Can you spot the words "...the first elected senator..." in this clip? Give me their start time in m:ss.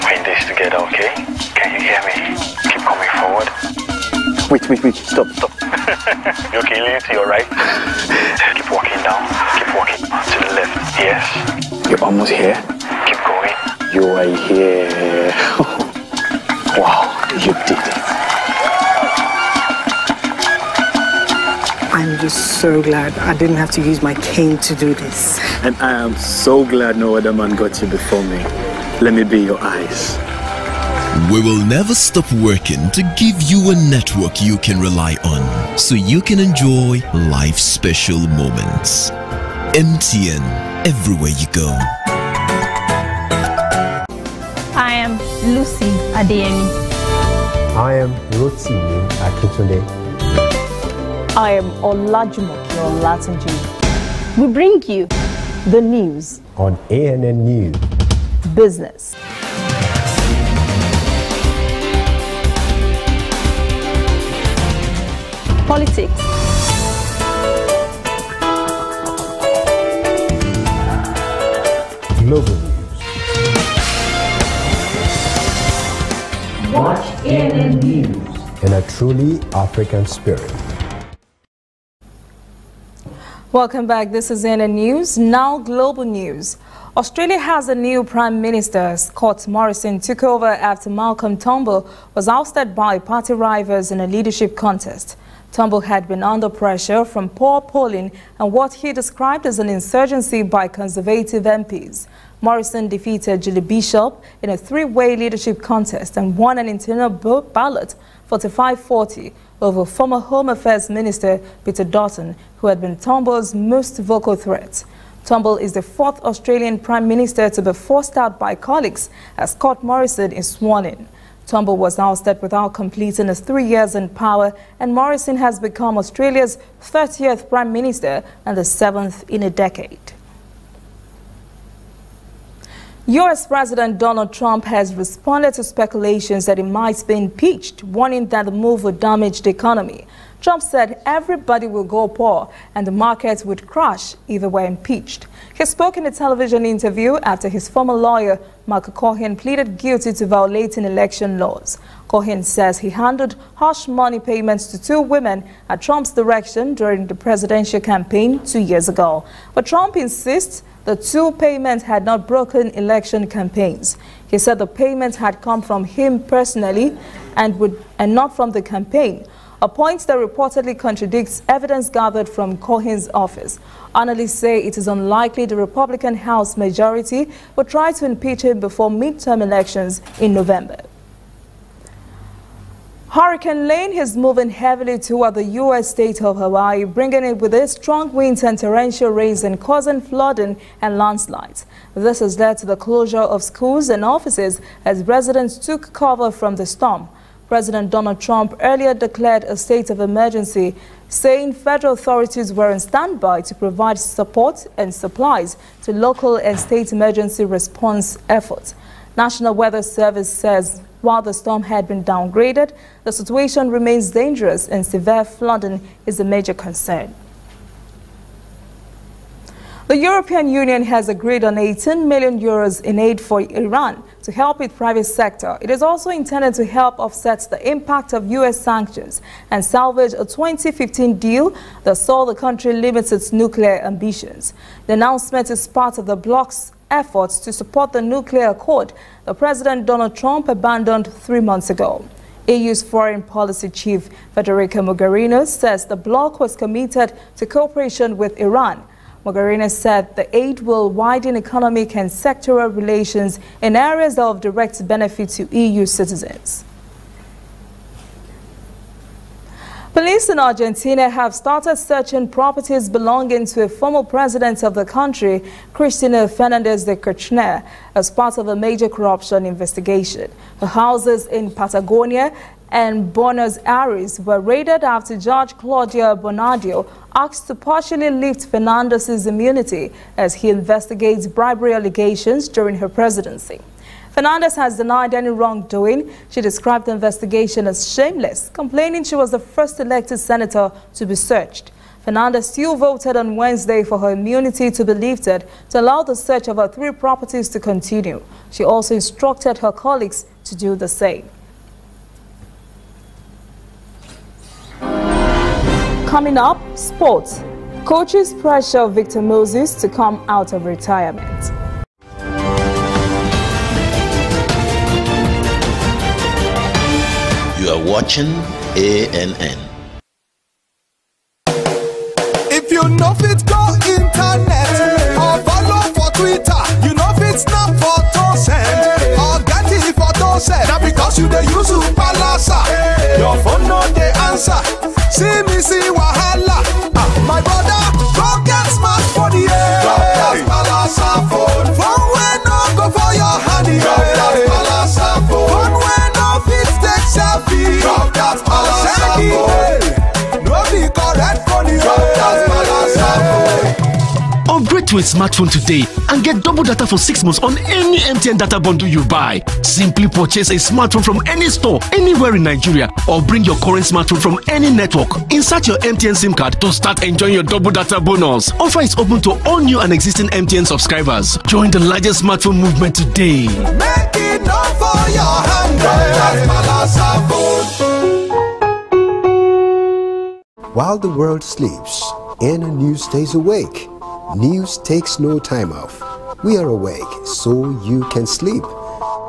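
4:49.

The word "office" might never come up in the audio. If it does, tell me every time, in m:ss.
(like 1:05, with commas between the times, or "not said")
2:53, 3:14.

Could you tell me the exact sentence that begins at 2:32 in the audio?
Cohen says he handed harsh money payments to two women at Trump's direction during the presidential campaign two years ago.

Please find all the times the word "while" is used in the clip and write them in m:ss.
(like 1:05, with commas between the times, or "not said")
3:31, 6:20.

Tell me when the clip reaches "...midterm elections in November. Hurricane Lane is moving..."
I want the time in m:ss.
2:58.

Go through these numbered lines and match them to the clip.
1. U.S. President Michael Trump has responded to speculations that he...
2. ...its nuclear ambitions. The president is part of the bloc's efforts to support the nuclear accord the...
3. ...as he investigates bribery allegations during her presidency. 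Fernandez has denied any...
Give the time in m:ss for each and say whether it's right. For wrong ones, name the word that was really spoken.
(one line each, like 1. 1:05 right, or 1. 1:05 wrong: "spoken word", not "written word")
1. 2:13 wrong: "Donald", not "Michael"
2. 3:53 wrong: "announcement", not "president"
3. 4:40 right.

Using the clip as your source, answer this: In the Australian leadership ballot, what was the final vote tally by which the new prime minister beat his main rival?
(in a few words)
45-40.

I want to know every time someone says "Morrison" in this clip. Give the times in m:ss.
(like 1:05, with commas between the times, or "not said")
1:29, 1:42, 1:59, 2:04.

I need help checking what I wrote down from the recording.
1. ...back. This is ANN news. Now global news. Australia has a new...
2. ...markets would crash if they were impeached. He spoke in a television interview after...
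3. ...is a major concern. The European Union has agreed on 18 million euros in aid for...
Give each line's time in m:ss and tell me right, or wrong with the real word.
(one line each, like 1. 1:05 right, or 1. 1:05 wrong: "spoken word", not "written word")
1. 1:23 right
2. 2:22 right
3. 3:36 right.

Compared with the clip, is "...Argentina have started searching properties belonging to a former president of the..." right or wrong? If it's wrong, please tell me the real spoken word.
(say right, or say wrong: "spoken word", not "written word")
right.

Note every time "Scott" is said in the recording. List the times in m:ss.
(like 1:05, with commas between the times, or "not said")
1:28, 1:59.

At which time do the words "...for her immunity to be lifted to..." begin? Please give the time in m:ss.
4:53.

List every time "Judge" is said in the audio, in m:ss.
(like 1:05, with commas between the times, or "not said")
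4:35.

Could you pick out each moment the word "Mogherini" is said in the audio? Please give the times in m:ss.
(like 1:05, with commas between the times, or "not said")
4:04, 4:09.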